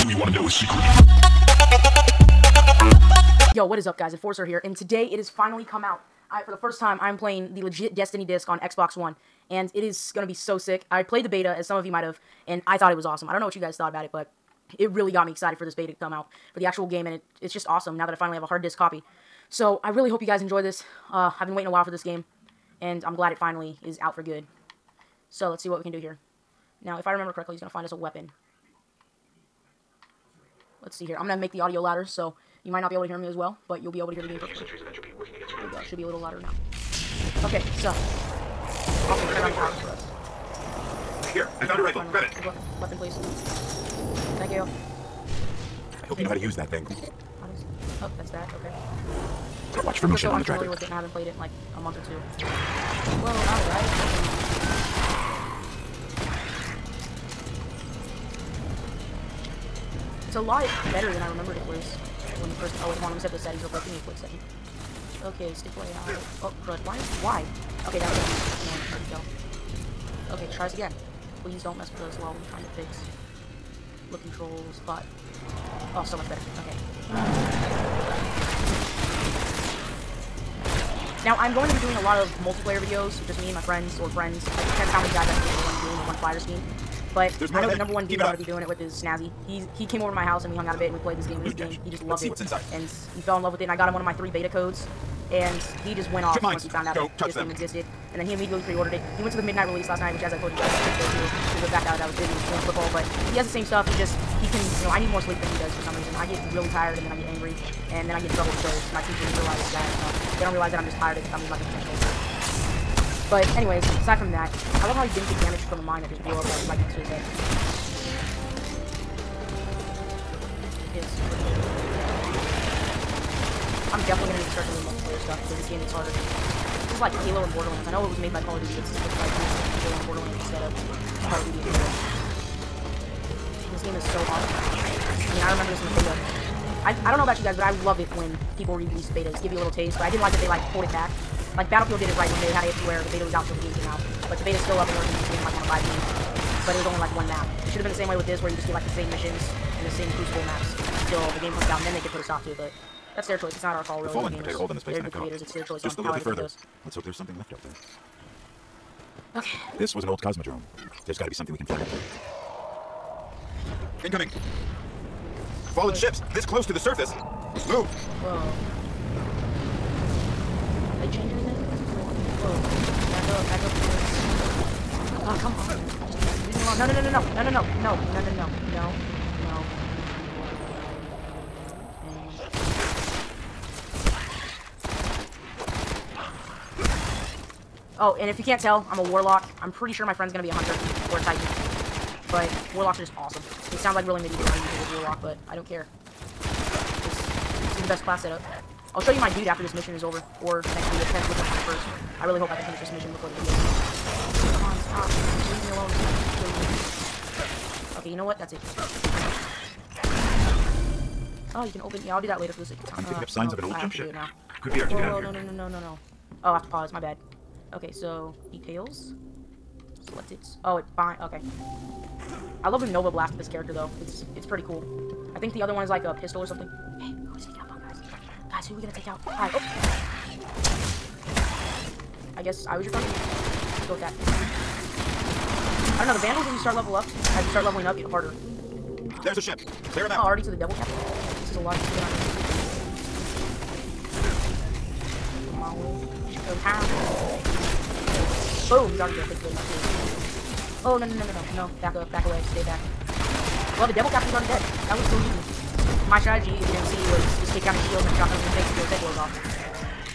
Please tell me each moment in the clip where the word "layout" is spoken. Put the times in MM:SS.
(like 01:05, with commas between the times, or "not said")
01:05.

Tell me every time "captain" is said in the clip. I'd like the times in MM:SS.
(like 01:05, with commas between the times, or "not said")
04:00, 04:14.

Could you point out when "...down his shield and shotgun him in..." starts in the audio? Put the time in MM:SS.
04:17.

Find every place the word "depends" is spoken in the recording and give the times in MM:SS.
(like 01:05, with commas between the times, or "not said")
01:24, 03:21.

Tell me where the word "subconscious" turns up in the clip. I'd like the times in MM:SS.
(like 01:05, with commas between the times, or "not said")
not said.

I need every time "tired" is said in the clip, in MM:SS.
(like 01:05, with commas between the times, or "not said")
01:46, 01:50.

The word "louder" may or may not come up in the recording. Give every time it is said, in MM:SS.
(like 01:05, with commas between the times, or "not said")
00:31, 00:36.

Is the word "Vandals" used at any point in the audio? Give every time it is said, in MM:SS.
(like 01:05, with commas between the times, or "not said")
03:56.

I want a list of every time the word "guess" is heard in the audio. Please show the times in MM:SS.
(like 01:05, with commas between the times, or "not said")
03:52.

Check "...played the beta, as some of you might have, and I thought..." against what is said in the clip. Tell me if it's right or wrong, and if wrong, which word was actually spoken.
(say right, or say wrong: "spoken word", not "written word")
right.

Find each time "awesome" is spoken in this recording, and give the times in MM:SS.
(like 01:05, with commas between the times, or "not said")
00:13, 00:17, 03:13.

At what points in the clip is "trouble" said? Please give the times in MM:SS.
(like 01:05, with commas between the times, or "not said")
01:48.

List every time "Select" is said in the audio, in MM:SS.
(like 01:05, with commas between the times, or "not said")
03:40.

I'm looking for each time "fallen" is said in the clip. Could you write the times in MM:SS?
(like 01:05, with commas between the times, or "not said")
02:34, 02:45.